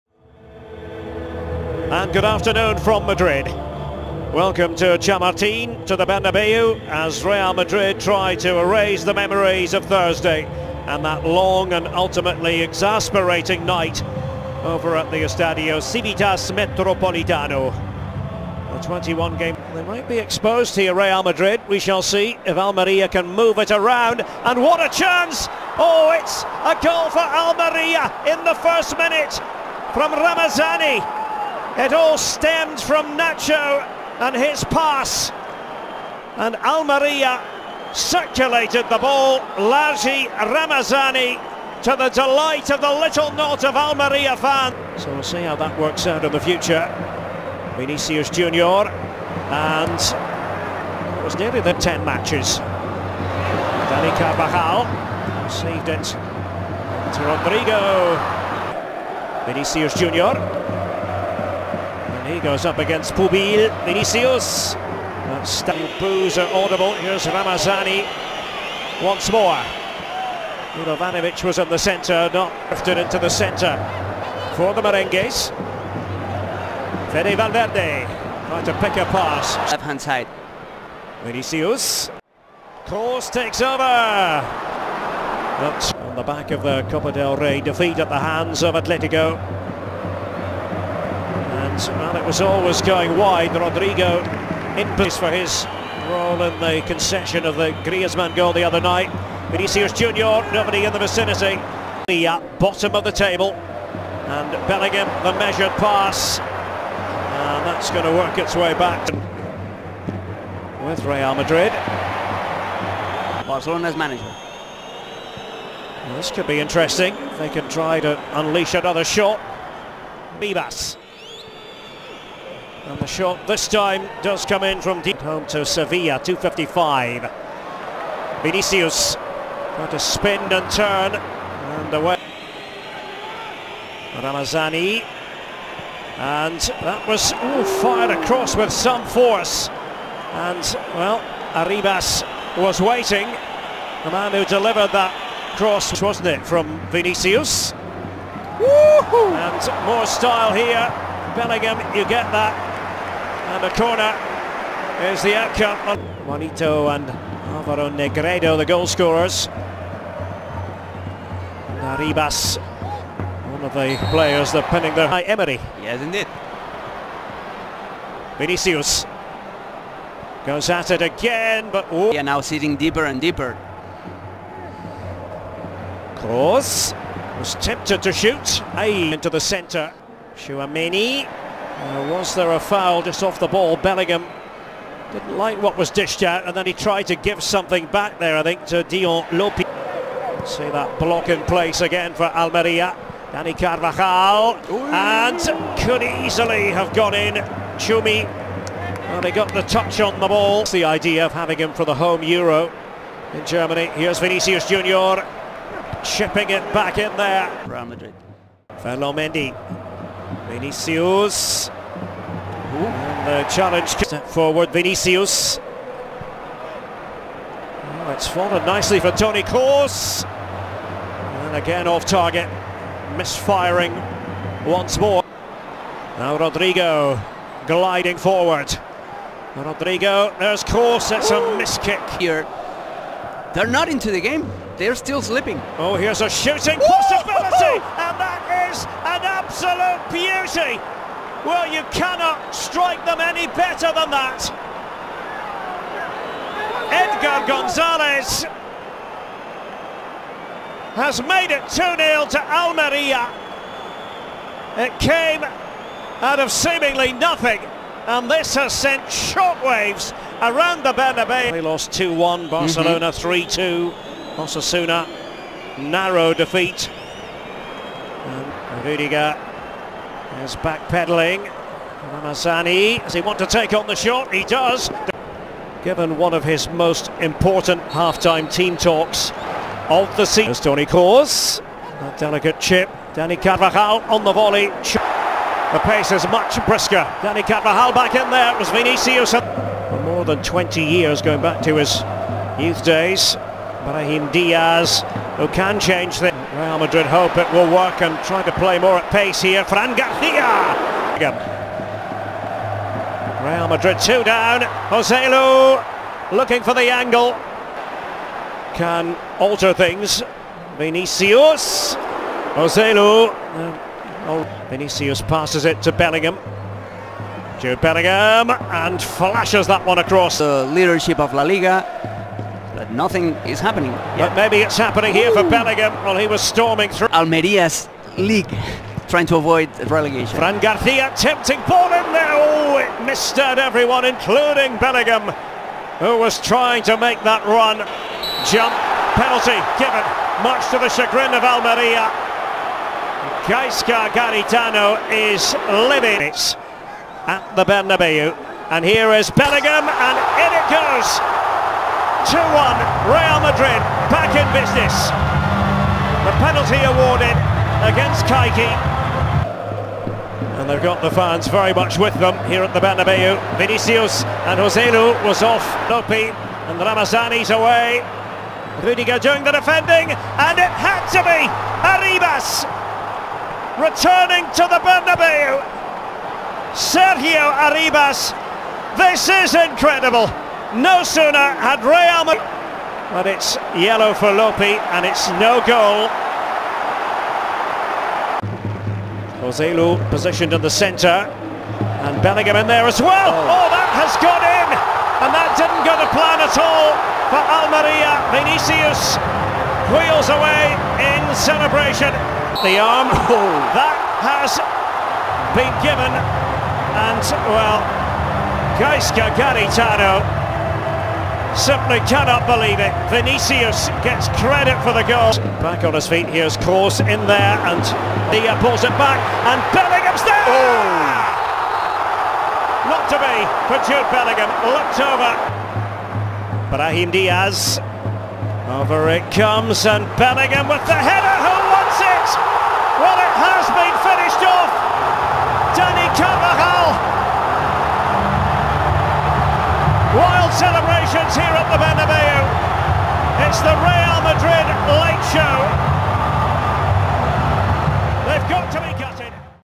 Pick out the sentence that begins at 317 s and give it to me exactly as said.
Joe Bellingham and flashes that one across.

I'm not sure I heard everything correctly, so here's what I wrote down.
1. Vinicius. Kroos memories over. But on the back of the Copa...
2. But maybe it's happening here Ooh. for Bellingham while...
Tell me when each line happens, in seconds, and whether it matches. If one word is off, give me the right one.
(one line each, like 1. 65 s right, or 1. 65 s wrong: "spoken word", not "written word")
1. 81 s wrong: "takes", not "memories"
2. 324 s right.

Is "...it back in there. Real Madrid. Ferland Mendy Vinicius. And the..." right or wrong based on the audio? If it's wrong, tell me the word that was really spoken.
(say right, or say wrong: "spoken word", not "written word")
right.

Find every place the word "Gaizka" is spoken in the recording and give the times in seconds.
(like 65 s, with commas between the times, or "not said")
343 s, 408 s.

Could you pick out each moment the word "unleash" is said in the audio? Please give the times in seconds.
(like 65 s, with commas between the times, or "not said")
118 s.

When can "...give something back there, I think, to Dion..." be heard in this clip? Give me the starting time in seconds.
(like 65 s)
187 s.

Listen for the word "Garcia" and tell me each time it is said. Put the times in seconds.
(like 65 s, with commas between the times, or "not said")
299 s, 330 s.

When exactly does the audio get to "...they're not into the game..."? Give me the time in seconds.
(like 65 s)
233 s.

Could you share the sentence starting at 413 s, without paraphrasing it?
Vinicius gets credit for the goal.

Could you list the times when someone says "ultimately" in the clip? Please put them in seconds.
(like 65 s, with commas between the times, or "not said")
11 s.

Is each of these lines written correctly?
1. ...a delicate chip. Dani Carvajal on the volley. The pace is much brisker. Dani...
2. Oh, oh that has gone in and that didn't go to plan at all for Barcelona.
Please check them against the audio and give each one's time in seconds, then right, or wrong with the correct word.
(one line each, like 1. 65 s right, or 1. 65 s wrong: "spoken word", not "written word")
1. 281 s right
2. 393 s wrong: "Almeria", not "Barcelona".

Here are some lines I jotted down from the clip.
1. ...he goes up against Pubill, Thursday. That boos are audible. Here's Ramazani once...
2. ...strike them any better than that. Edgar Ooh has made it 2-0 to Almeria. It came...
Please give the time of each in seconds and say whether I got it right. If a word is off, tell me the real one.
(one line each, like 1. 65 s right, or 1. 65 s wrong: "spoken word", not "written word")
1. 62 s wrong: "Vinicius", not "Thursday"
2. 242 s wrong: "Gonzalez", not "Ooh".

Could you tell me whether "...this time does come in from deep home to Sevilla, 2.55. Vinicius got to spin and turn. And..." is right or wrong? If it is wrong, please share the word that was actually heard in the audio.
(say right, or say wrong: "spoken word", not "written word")
right.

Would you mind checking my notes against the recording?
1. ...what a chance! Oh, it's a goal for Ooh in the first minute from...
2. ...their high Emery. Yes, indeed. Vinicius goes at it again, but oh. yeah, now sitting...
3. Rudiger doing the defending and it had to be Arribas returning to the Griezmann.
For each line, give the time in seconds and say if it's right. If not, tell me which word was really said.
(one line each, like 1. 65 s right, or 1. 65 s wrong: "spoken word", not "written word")
1. 24 s wrong: "Almeria", not "Ooh"
2. 164 s right
3. 368 s wrong: "Bernabeu", not "Griezmann".